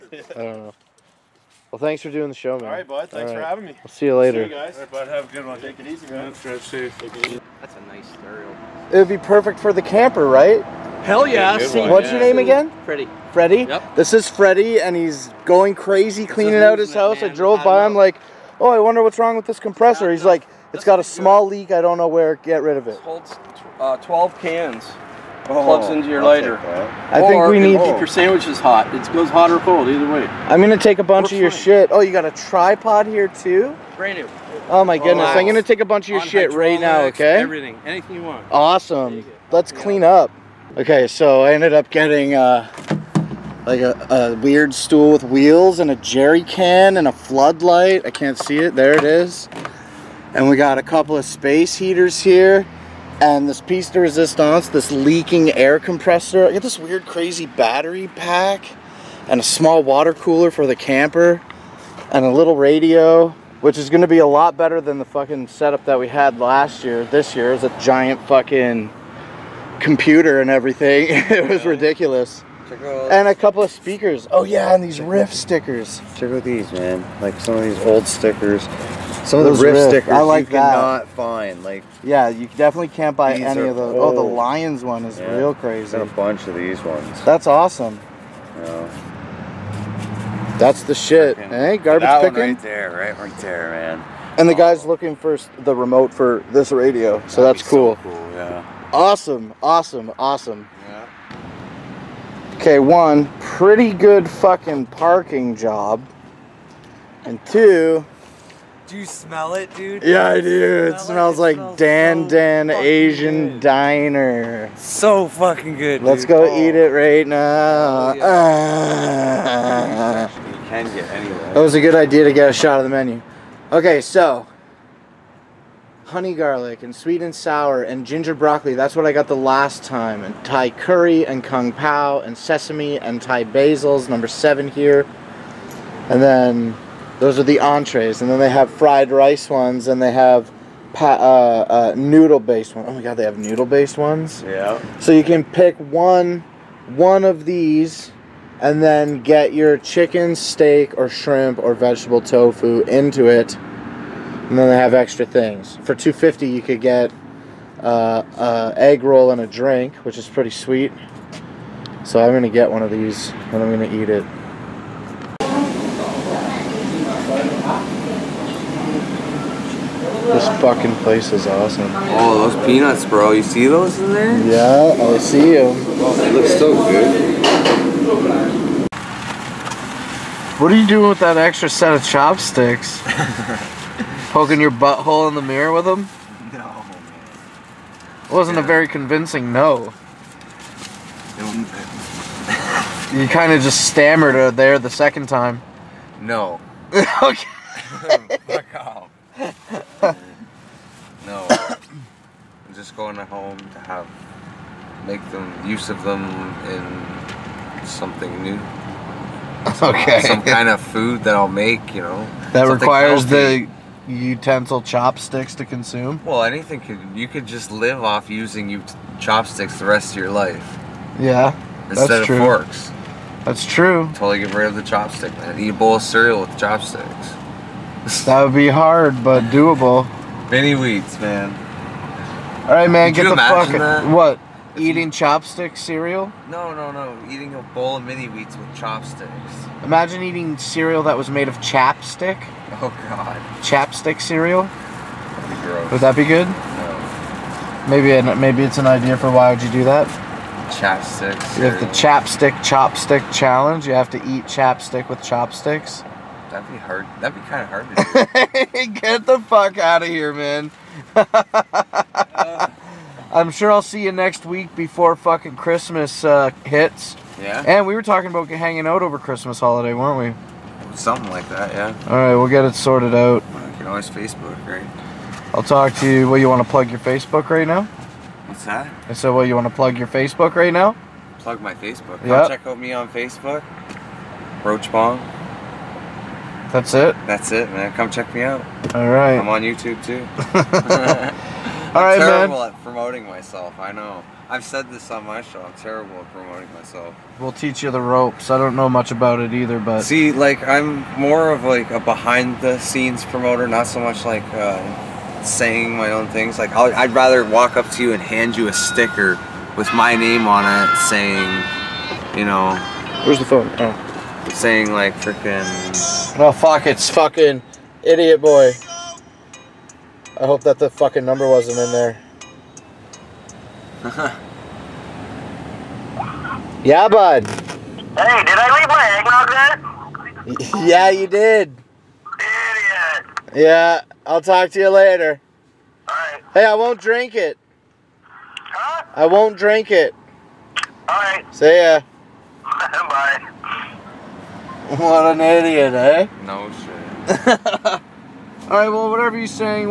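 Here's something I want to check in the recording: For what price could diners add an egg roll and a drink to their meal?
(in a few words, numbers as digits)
250.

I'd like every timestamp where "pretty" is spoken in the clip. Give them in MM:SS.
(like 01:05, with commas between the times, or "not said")
00:12, 01:43, 02:40.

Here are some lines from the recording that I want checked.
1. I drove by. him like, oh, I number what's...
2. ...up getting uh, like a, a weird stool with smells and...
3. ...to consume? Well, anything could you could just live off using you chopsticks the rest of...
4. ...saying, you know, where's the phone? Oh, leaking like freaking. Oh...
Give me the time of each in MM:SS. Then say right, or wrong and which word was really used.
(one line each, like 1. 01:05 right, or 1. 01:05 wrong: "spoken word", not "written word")
1. 00:17 wrong: "wonder", not "number"
2. 00:41 wrong: "wheels", not "smells"
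3. 03:35 right
4. 05:10 wrong: "saying", not "leaking".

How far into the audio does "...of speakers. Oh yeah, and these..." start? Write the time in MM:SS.
01:13.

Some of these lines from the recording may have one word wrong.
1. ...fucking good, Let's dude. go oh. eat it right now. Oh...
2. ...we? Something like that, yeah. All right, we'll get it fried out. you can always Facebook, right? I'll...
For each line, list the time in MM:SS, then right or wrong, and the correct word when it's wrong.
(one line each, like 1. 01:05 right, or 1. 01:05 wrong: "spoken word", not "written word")
1. 01:55 right
2. 04:30 wrong: "sorted", not "fried".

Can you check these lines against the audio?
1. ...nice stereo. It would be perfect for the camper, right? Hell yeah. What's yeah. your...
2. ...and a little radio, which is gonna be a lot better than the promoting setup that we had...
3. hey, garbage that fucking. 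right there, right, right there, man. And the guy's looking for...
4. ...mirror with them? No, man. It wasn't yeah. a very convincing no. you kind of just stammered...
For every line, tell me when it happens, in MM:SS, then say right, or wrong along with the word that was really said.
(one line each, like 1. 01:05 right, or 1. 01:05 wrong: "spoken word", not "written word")
1. 00:07 right
2. 01:02 wrong: "fucking", not "promoting"
3. 01:31 wrong: "picking", not "fucking"
4. 03:05 right.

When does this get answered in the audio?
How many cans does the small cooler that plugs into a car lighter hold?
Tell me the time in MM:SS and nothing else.
00:23.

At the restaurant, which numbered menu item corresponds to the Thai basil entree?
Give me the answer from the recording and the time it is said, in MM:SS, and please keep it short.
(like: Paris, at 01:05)
7, at 02:14.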